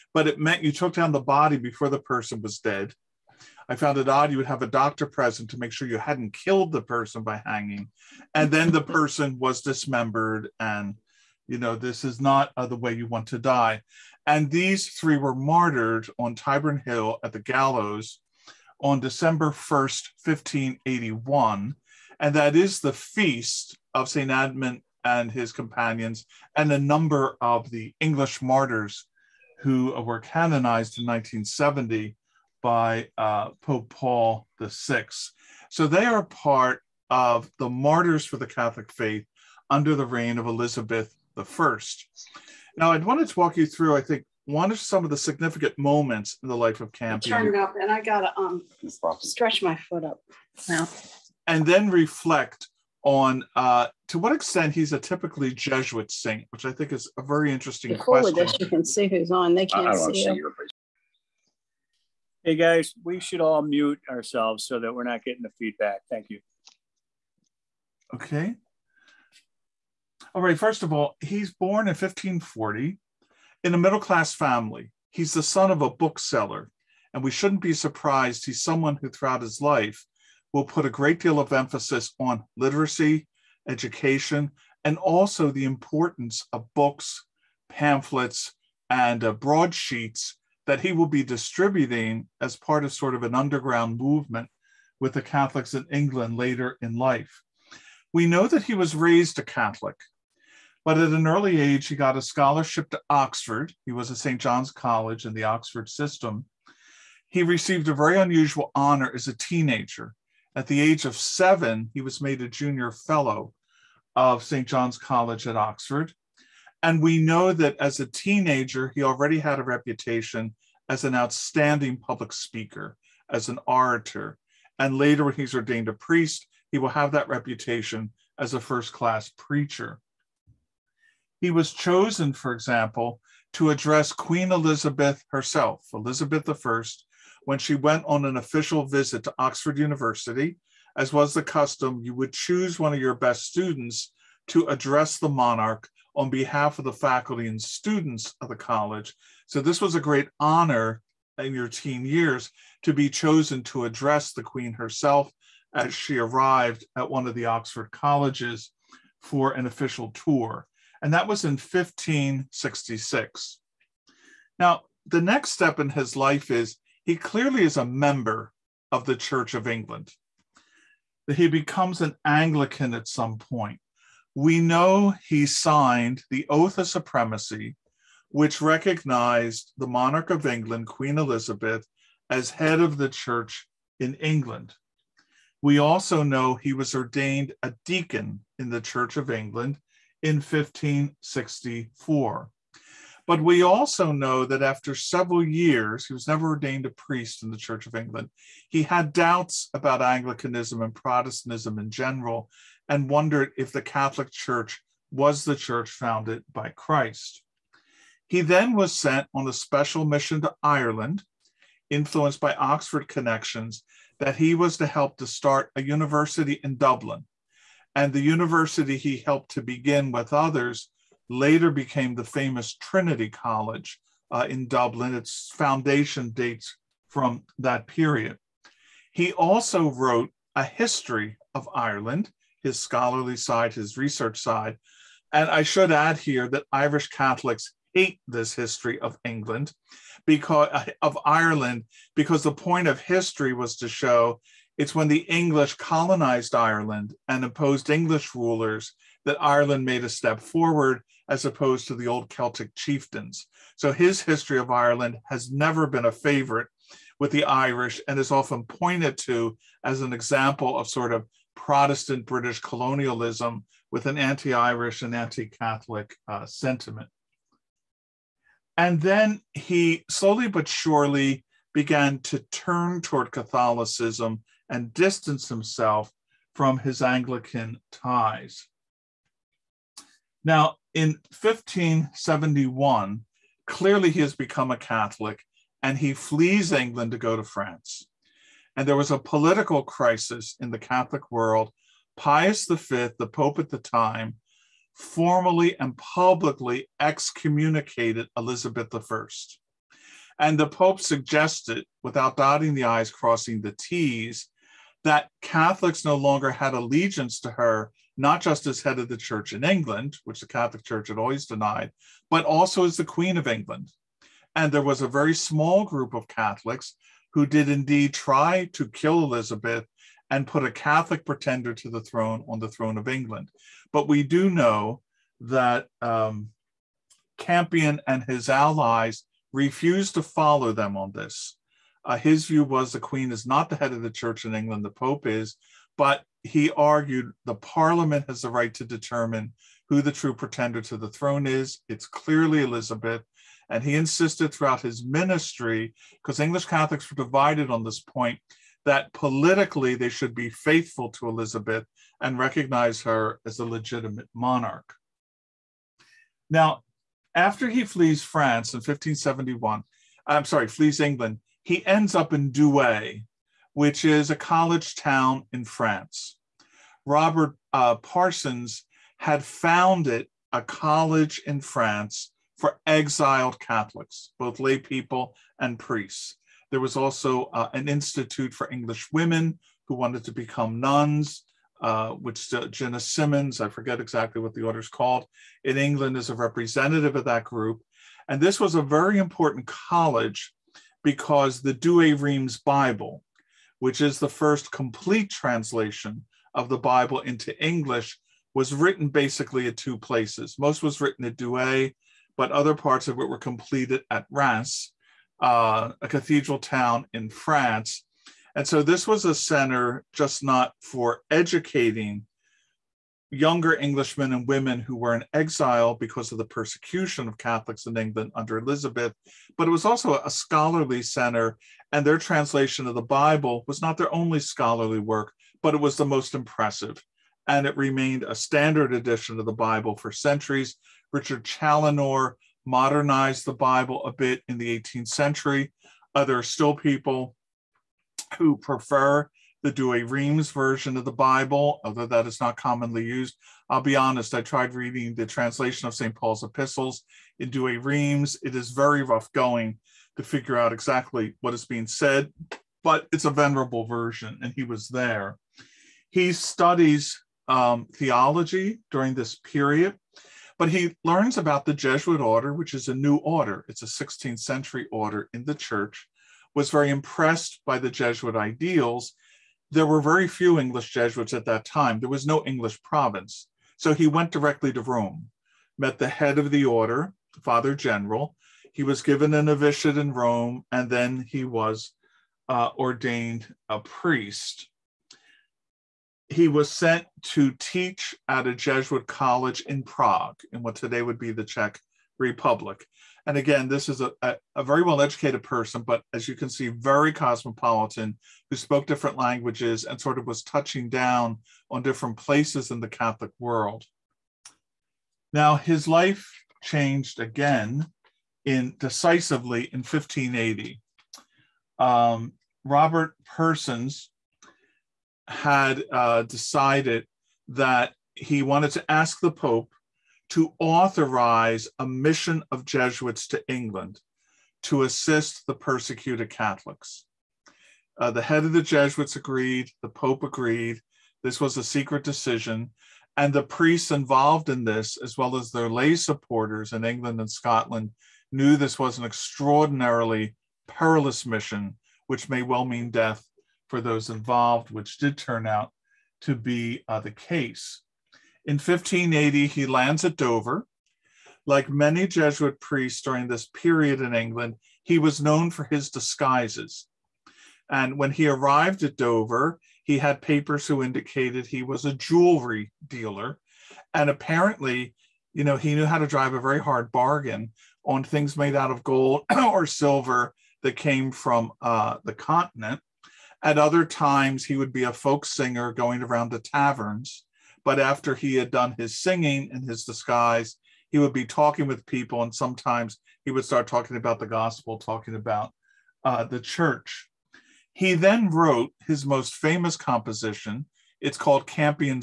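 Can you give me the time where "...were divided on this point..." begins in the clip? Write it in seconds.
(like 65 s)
347 s.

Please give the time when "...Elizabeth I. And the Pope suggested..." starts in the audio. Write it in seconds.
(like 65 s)
298 s.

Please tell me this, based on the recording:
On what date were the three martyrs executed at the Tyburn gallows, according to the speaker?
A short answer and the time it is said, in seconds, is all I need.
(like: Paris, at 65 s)
December 1st, 1581, at 18 s.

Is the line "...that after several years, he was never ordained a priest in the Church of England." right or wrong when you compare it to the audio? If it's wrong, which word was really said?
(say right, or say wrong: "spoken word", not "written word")
right.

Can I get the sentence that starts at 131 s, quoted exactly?
He was chosen, for example, to address Queen Elizabeth herself, Elizabeth I, when she went on an official visit to Oxford University.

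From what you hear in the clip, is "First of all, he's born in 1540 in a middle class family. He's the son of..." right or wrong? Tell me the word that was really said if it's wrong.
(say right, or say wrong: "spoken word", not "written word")
right.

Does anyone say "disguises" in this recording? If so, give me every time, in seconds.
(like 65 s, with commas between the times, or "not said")
555 s, 579 s.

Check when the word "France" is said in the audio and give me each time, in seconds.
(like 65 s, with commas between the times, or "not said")
287 s, 358 s, 365 s, 371 s, 407 s.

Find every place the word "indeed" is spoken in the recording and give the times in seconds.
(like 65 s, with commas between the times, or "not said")
317 s.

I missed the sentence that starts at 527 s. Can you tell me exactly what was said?
Uh, the head of the Jesuits agreed, the Pope agreed.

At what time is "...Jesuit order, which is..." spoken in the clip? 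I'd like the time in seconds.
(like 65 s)
461 s.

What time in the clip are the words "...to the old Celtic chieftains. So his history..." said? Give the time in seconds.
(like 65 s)
251 s.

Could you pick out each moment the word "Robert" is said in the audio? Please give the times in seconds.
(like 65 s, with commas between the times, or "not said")
367 s, 512 s.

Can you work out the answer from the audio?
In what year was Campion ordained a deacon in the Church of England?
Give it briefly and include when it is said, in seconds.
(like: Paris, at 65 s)
1564, at 190 s.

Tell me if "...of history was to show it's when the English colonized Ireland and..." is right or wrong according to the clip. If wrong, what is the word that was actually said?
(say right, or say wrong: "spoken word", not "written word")
right.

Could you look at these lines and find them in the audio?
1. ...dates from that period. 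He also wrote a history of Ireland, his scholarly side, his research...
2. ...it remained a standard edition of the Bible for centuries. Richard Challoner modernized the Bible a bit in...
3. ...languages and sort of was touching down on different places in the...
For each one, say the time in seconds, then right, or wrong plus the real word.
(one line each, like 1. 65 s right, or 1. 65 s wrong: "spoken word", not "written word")
1. 226 s right
2. 427 s right
3. 499 s right.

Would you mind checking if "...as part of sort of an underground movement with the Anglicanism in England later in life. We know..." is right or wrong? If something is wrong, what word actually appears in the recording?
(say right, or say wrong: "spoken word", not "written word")
wrong: "Catholics", not "Anglicanism".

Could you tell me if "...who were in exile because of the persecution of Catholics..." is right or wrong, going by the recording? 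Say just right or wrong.
right.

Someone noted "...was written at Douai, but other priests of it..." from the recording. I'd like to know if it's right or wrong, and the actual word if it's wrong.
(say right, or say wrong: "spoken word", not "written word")
wrong: "parts", not "priests".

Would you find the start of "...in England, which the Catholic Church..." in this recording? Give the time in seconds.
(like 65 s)
309 s.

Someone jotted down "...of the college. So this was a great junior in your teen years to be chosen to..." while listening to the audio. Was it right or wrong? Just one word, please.
wrong.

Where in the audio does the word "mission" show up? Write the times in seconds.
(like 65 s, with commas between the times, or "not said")
210 s, 521 s, 541 s.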